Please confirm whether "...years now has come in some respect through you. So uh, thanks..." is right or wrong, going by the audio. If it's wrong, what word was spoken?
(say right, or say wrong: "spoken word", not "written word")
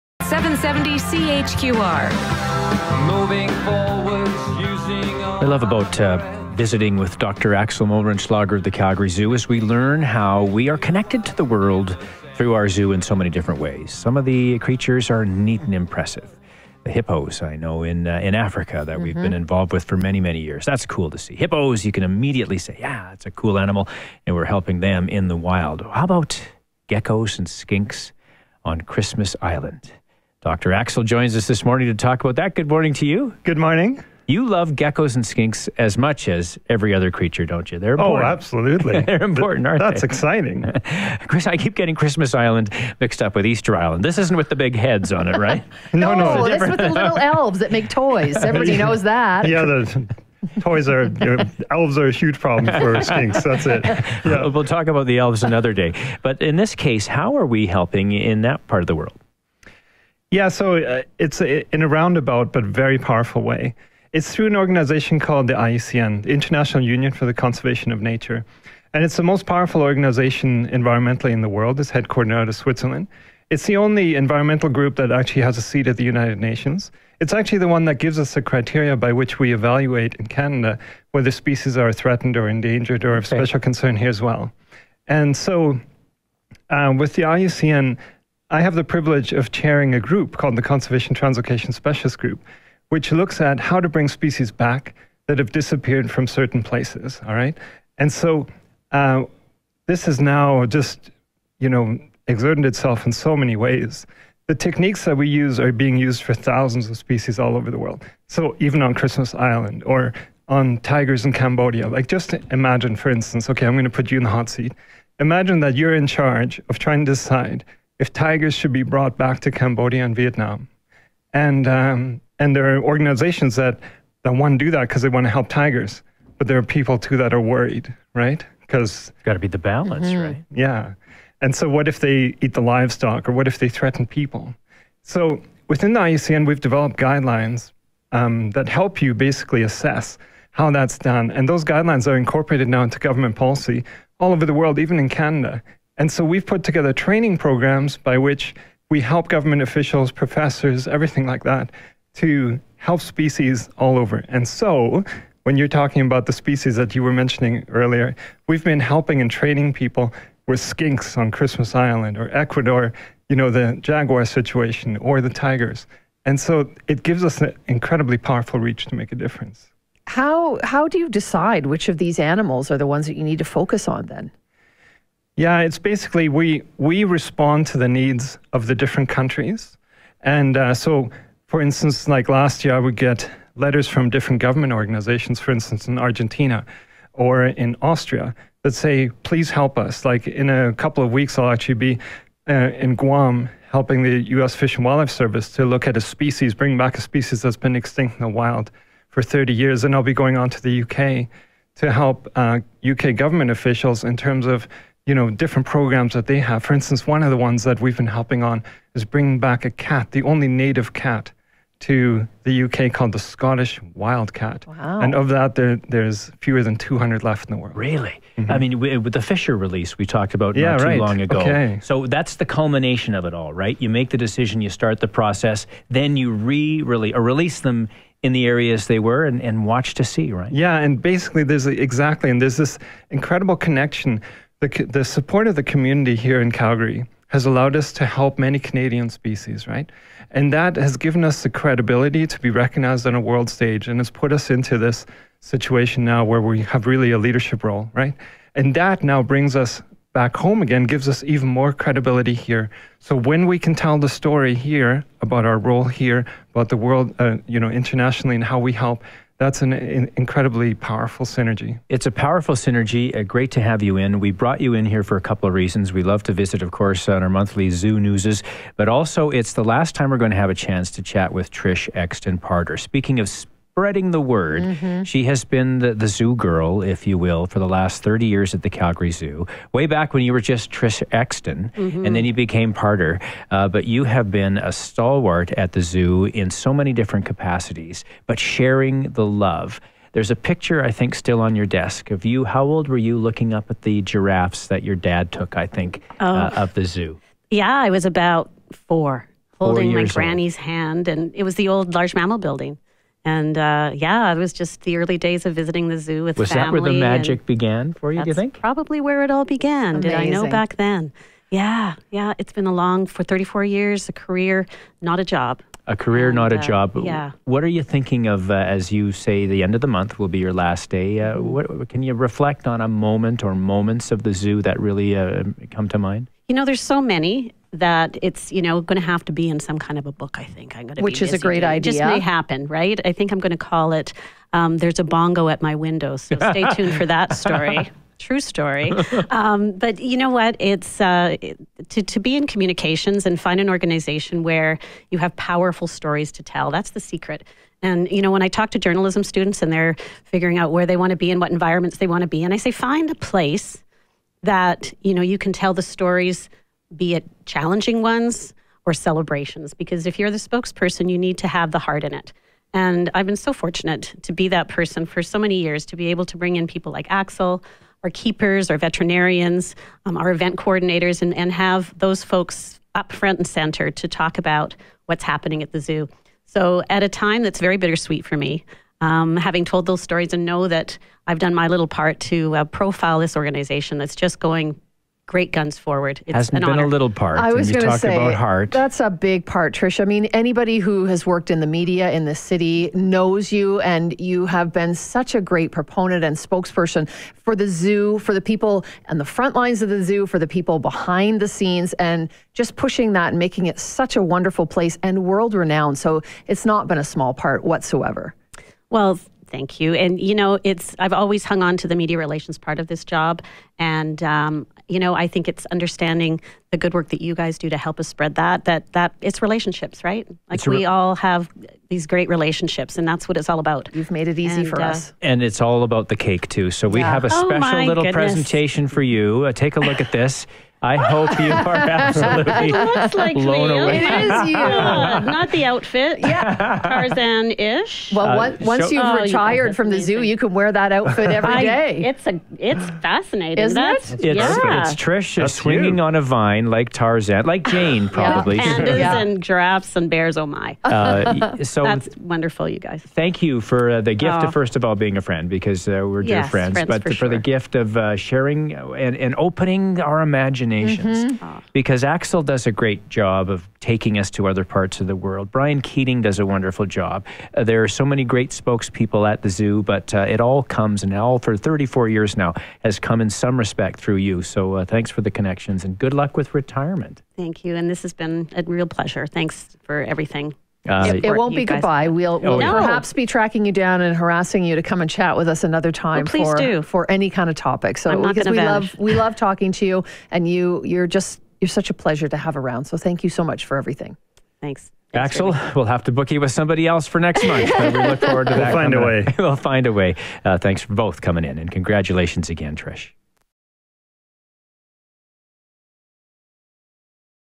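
right.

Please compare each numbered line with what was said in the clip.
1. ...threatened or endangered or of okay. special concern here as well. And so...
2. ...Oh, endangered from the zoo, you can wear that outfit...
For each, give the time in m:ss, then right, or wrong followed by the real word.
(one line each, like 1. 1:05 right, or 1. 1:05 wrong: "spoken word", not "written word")
1. 1:21 right
2. 7:19 wrong: "retired", not "endangered".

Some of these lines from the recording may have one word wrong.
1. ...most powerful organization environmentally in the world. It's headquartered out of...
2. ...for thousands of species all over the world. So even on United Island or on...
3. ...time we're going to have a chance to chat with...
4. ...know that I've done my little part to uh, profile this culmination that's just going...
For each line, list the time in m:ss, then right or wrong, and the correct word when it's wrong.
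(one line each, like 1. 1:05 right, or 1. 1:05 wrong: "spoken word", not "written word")
1. 1:09 right
2. 1:46 wrong: "Christmas", not "United"
3. 4:29 right
4. 6:20 wrong: "organization", not "culmination".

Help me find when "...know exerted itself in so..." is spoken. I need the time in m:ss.
1:41.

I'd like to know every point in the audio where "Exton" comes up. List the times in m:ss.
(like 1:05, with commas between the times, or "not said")
4:31, 4:41.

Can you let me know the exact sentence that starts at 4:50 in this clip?
There's a picture, I think, still on your desk of you.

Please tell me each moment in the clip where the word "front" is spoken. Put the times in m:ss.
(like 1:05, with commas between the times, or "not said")
6:13, 6:39.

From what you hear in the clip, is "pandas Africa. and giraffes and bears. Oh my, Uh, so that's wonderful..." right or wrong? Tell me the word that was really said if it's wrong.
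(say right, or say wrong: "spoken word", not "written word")
wrong: "Yeah", not "Africa".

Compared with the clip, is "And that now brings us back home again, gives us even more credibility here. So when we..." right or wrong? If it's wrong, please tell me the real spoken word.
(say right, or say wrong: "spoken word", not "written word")
right.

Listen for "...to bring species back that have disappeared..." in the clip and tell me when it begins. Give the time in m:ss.
1:33.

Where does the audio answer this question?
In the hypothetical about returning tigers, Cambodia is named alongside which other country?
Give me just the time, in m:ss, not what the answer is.
2:00.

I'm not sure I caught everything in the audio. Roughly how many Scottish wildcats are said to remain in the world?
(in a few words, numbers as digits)
fewer than 200.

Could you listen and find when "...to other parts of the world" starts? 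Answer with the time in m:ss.
7:44.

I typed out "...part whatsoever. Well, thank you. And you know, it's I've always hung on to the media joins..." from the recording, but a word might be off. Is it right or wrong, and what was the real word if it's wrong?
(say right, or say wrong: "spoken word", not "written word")
wrong: "relations", not "joins".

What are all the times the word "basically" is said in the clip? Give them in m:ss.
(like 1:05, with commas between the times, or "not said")
2:19, 2:55, 3:51.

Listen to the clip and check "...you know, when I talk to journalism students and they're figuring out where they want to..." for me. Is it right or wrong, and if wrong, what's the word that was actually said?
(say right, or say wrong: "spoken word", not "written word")
right.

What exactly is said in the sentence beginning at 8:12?
So thank you so much for everything.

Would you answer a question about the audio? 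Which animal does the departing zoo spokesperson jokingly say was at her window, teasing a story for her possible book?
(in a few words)
bongo.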